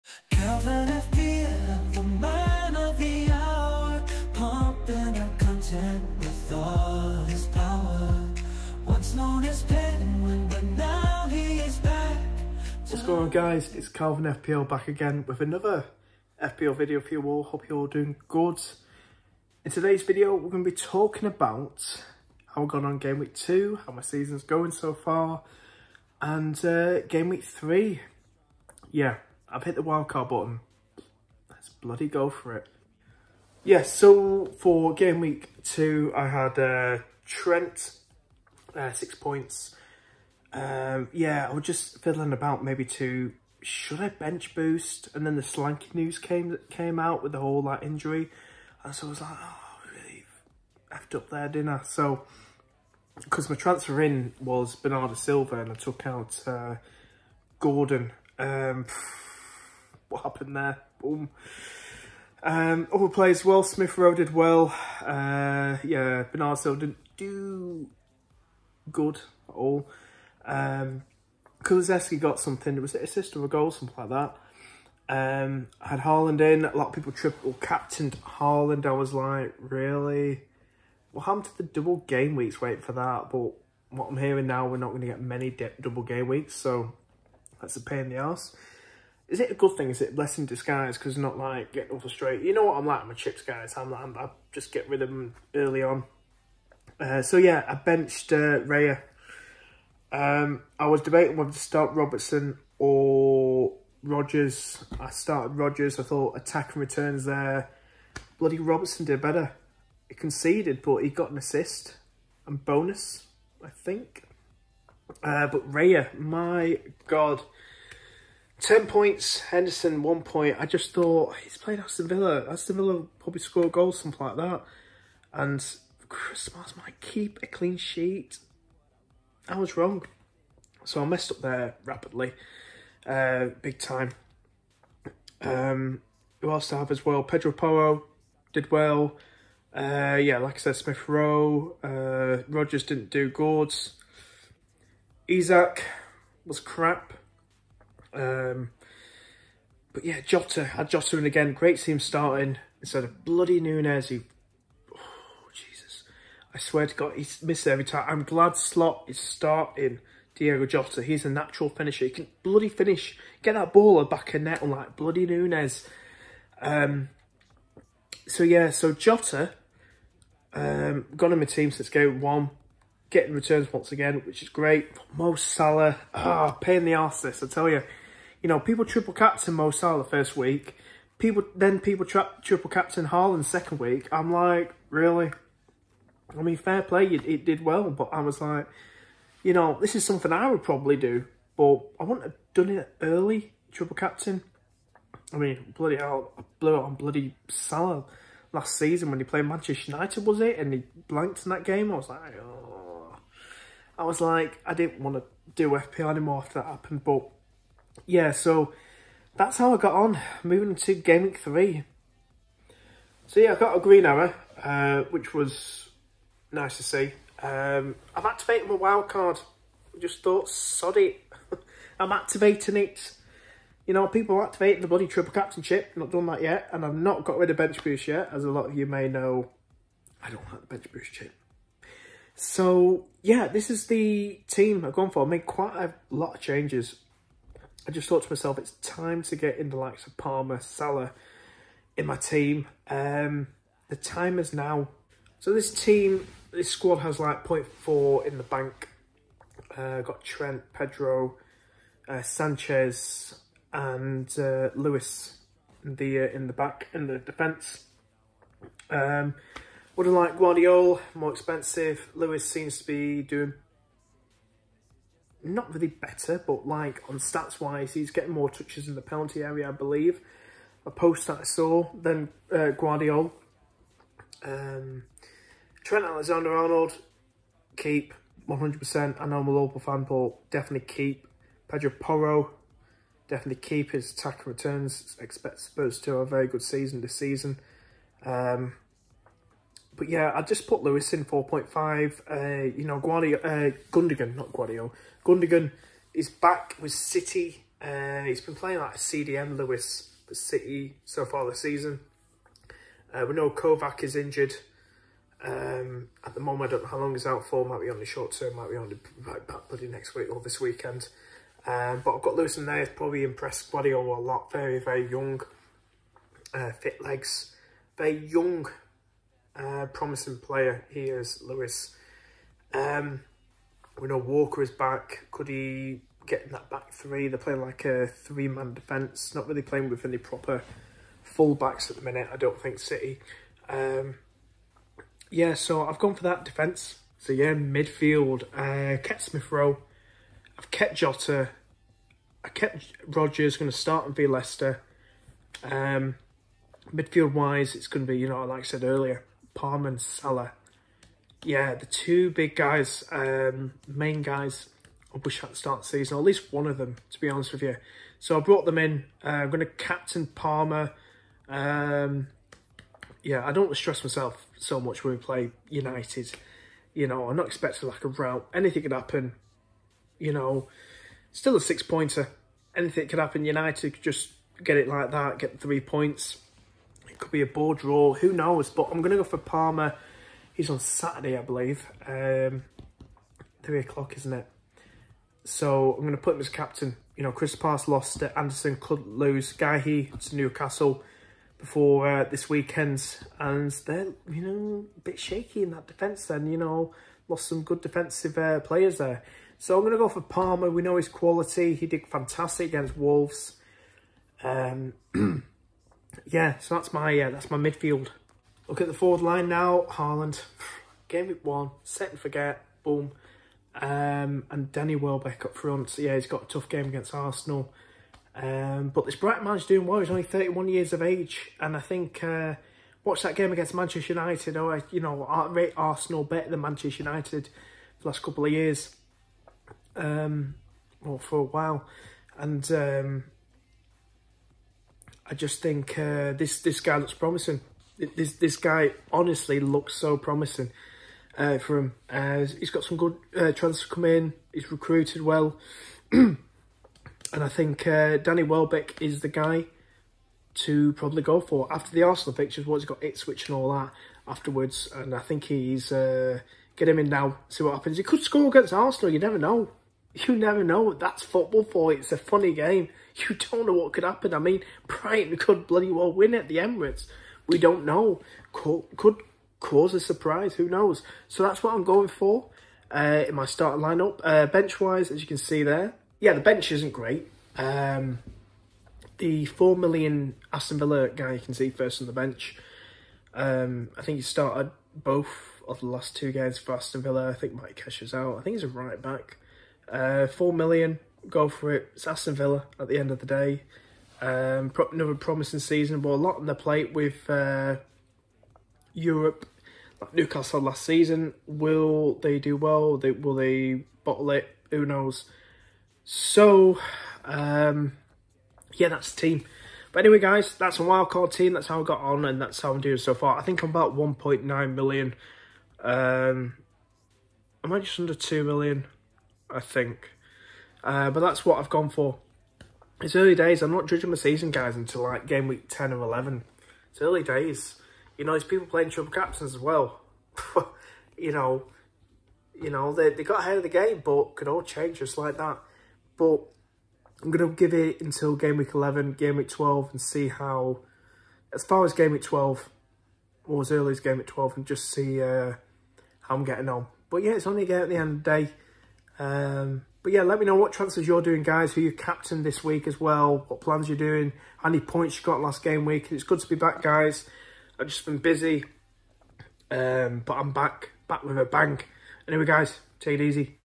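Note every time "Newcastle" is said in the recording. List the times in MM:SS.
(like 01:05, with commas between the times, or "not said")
06:30, 08:20.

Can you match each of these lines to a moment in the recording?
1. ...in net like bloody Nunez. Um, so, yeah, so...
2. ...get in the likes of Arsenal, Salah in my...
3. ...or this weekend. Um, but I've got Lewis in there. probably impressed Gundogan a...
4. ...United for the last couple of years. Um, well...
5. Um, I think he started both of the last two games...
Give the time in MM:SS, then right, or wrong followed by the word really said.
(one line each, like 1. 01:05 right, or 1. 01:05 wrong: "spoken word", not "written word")
1. 02:44 right
2. 03:59 wrong: "Palmer", not "Arsenal"
3. 05:10 wrong: "Guardiola", not "Gundogan"
4. 07:07 right
5. 08:03 right.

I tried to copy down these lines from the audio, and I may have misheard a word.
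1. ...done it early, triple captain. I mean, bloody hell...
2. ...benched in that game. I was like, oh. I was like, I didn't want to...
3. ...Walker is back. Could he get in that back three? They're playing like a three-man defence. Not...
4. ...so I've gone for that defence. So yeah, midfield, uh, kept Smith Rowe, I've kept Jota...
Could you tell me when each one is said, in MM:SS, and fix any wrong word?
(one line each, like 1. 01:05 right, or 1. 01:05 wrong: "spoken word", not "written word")
1. 03:12 right
2. 03:21 wrong: "blanked", not "benched"
3. 05:24 right
4. 05:35 right.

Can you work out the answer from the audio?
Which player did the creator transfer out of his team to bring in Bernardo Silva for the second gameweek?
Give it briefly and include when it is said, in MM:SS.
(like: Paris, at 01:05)
Gordon, at 00:57.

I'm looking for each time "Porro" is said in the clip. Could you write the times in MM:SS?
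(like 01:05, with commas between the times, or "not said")
02:17, 04:41.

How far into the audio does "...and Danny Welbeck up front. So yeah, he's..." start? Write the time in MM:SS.
06:54.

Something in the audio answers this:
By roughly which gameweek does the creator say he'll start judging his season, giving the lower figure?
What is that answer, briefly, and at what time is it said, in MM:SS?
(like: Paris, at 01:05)
10, at 08:45.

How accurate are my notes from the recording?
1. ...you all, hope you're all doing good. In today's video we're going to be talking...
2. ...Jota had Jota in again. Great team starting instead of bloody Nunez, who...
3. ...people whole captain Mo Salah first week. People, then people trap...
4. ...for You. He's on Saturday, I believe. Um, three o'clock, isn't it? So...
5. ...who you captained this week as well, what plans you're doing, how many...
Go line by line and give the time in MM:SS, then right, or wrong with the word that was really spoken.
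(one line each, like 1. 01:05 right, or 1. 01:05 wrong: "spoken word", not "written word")
1. 00:17 right
2. 02:30 right
3. 02:58 wrong: "triple", not "whole"
4. 06:19 wrong: "Palmer", not "You"
5. 09:11 right.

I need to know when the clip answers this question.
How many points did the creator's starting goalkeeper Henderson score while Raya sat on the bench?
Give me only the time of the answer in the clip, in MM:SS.
02:00.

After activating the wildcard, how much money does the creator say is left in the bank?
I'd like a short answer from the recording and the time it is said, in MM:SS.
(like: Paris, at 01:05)
0.4, at 04:07.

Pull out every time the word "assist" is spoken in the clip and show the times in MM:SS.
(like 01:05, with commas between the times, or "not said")
01:13, 01:51.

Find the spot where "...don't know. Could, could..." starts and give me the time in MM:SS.
07:47.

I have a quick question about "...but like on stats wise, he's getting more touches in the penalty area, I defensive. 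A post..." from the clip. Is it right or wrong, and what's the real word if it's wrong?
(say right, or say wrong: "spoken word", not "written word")
wrong: "believe", not "defensive".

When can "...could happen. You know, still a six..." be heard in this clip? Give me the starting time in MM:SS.
06:08.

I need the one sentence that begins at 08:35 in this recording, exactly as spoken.
Um, am I just under 2 million?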